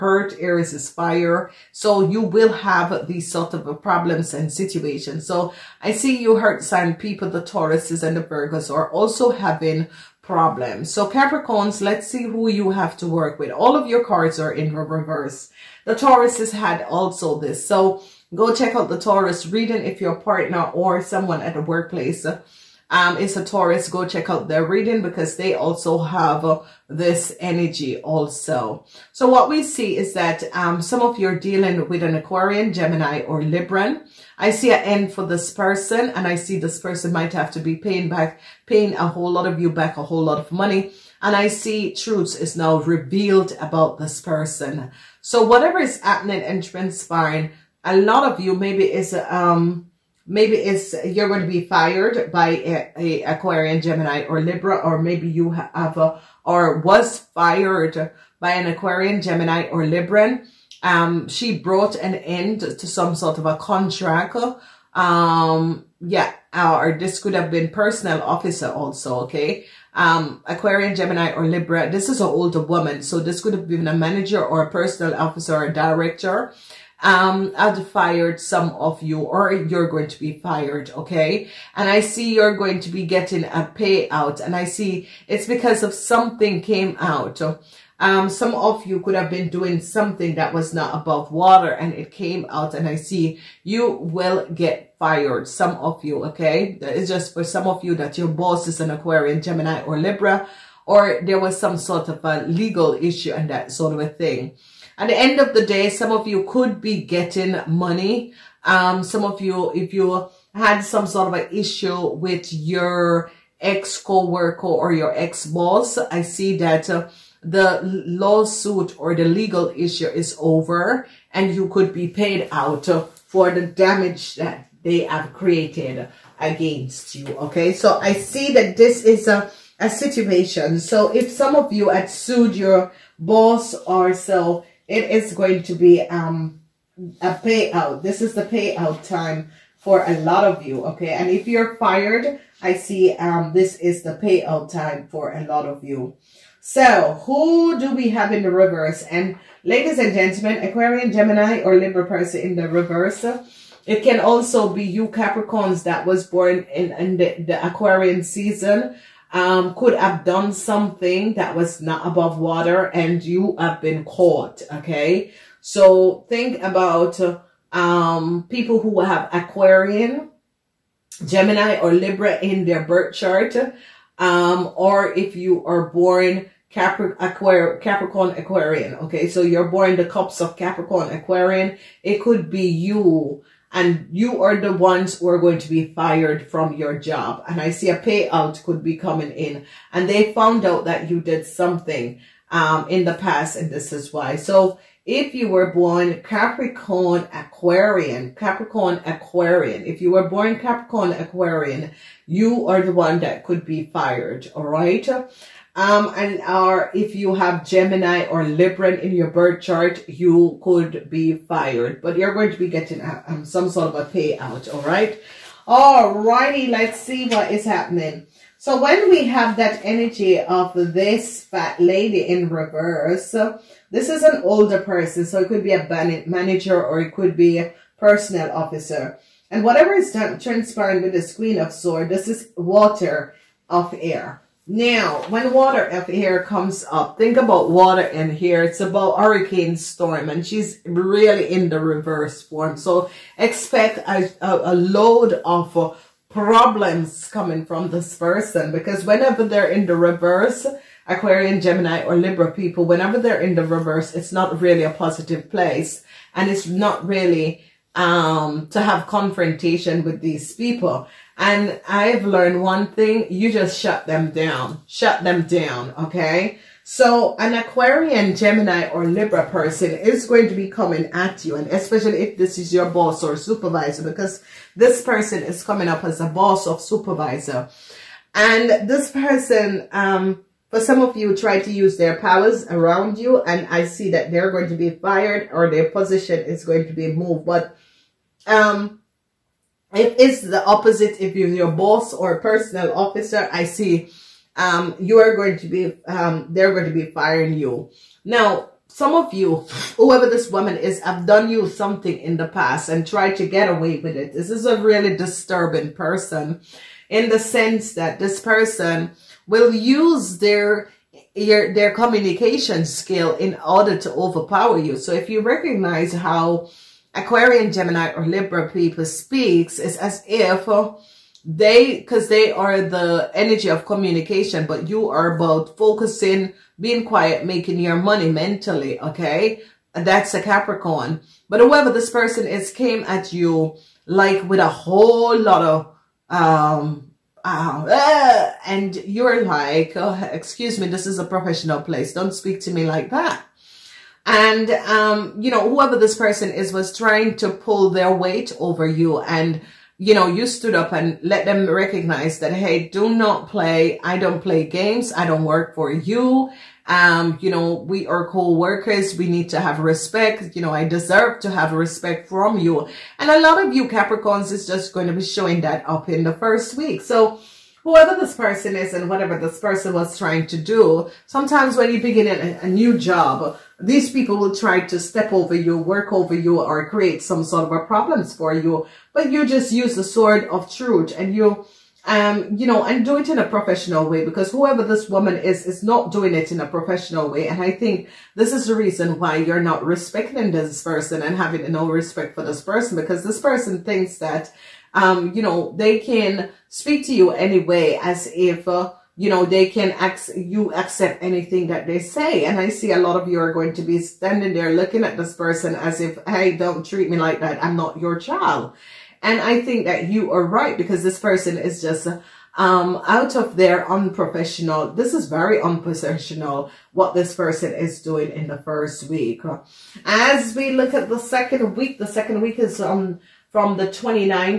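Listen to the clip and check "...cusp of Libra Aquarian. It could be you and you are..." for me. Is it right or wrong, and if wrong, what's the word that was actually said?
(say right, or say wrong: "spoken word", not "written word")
wrong: "Capricorn", not "Libra".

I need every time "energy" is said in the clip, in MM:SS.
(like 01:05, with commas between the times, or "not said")
00:27, 03:39, 05:23.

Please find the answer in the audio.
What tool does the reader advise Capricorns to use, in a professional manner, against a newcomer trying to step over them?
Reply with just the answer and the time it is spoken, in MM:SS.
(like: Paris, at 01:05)
the sword of truth, at 06:19.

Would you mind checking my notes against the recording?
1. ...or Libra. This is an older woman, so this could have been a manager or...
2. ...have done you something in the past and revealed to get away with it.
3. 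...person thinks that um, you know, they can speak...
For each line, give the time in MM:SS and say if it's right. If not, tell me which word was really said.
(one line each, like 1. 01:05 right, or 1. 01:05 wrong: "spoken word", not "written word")
1. 01:11 right
2. 05:01 wrong: "tried", not "revealed"
3. 06:33 right.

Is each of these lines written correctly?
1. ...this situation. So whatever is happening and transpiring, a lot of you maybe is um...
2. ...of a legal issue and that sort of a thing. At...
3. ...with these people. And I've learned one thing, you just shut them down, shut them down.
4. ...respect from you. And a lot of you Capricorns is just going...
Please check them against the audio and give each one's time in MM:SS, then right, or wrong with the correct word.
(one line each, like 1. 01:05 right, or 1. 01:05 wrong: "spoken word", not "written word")
1. 00:43 wrong: "person", not "situation"
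2. 01:42 right
3. 04:20 right
4. 06:01 right.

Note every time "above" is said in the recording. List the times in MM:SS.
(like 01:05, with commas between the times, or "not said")
01:30, 02:42.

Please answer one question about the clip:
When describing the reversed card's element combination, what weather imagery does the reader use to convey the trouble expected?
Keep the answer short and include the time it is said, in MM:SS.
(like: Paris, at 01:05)
hurricane storm, at 03:59.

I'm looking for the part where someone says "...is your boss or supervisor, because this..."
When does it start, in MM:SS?
04:32.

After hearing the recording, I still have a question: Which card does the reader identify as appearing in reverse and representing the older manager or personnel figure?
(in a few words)
Queen of Swords.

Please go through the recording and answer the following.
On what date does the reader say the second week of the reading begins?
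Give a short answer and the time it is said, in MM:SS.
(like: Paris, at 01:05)
the 29th, at 07:03.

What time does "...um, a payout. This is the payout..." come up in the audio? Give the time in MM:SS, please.
02:16.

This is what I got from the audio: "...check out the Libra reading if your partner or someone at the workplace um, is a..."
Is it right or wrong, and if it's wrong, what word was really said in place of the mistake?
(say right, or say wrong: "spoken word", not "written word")
wrong: "Taurus", not "Libra".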